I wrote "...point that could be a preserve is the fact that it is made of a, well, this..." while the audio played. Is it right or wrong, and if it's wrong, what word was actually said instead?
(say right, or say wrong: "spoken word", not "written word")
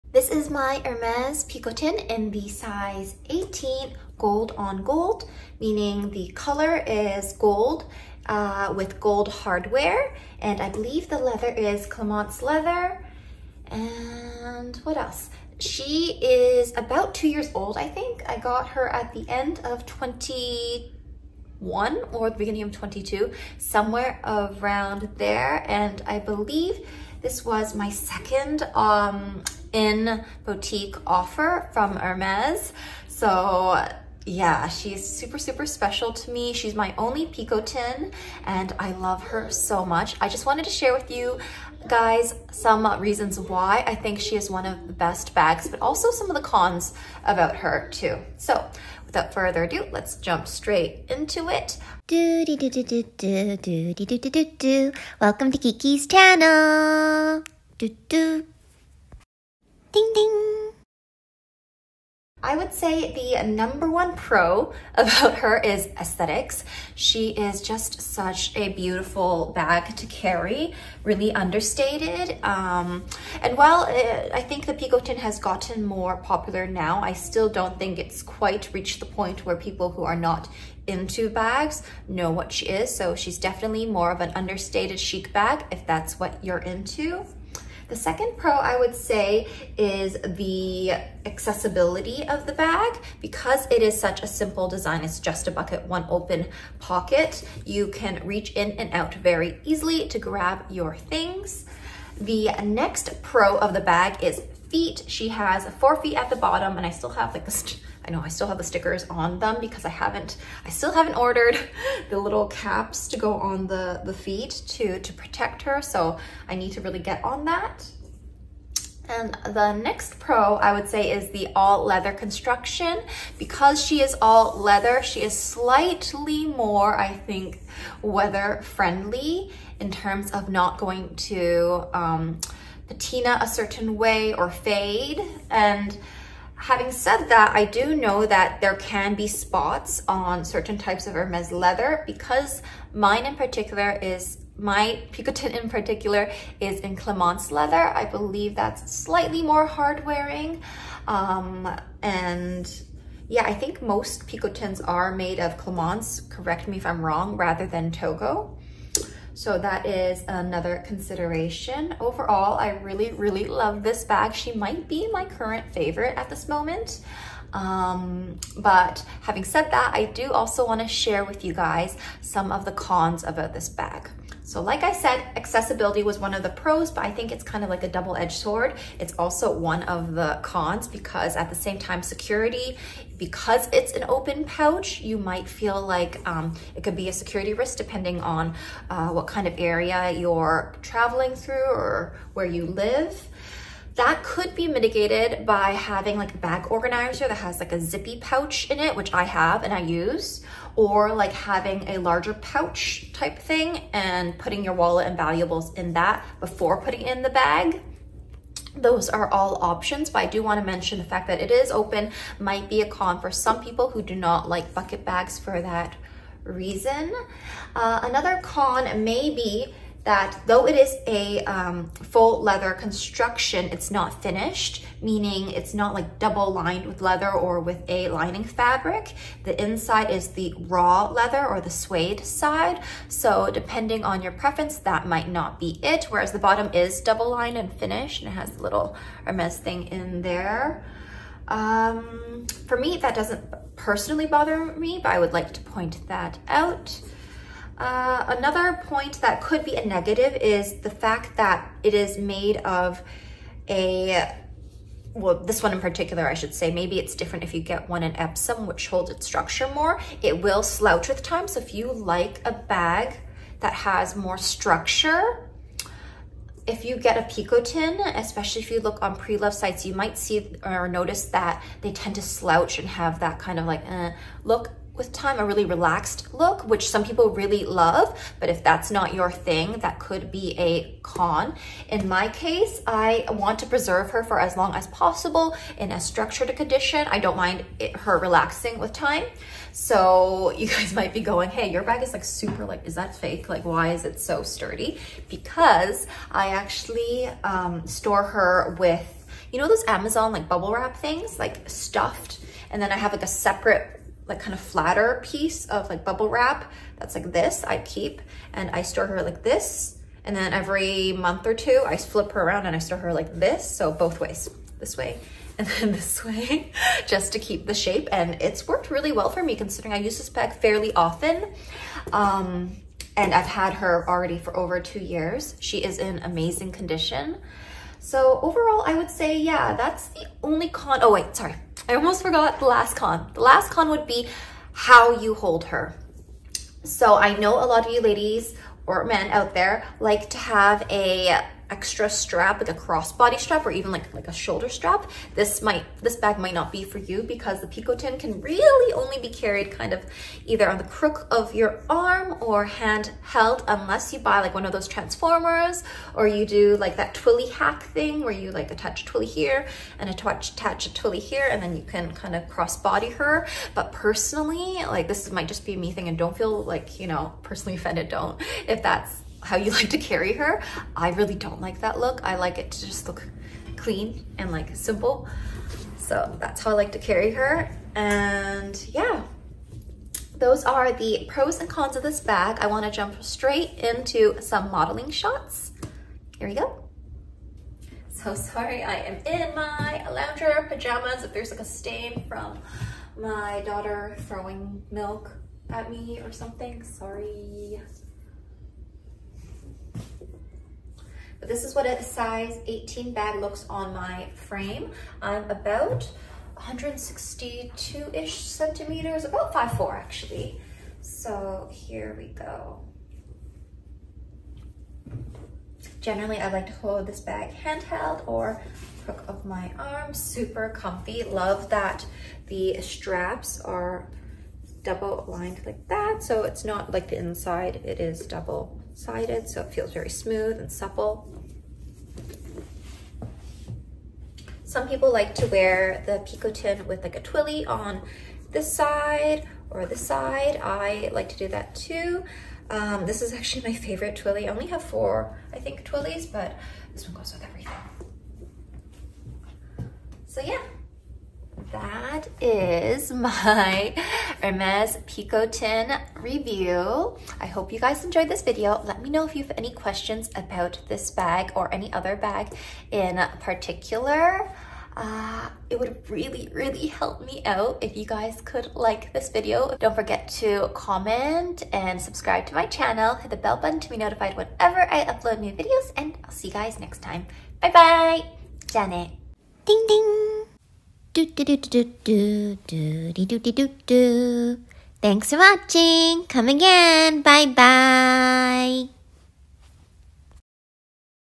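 wrong: "negative", not "preserve".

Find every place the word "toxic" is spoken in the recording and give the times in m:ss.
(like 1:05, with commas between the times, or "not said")
not said.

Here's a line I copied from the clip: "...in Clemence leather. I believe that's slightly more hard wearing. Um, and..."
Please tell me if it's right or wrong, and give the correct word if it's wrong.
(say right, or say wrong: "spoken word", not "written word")
right.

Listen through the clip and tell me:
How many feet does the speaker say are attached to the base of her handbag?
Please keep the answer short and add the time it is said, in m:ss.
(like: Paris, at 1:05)
4, at 1:45.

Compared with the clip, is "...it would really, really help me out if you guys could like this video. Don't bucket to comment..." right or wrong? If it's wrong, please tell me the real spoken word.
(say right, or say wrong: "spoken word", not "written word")
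wrong: "forget", not "bucket".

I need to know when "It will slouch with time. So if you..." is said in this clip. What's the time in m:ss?
4:20.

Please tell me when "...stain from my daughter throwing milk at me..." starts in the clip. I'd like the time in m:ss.
6:31.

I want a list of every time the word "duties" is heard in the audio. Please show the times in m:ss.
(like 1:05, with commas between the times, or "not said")
not said.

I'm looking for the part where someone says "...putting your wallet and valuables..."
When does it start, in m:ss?
3:24.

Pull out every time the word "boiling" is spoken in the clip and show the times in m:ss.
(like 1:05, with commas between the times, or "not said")
not said.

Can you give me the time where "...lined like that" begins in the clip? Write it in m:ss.
7:05.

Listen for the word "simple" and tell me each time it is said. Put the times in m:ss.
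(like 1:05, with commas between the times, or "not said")
1:34, 6:14.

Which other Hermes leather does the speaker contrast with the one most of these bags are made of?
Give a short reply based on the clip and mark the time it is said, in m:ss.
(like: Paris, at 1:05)
Togo, at 2:37.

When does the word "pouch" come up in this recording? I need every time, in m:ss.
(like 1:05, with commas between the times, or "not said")
3:04, 3:18, 3:22.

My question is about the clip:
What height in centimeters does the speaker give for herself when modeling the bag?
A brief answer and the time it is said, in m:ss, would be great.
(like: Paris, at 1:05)
162, at 6:46.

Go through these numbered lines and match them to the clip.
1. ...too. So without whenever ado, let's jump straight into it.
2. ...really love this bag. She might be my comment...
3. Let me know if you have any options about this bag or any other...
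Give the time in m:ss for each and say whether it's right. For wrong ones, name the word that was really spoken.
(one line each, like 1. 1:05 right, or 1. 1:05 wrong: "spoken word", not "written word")
1. 0:47 wrong: "further", not "whenever"
2. 2:43 wrong: "current", not "comment"
3. 7:38 wrong: "questions", not "options".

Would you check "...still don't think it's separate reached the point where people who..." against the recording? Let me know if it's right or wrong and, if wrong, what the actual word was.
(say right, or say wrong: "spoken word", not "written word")
wrong: "quite", not "separate".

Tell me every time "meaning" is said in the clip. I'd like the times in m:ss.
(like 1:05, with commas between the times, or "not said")
0:05, 3:45.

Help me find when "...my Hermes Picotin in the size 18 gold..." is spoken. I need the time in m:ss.
0:00.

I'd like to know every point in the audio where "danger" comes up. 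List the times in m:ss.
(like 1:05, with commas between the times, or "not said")
not said.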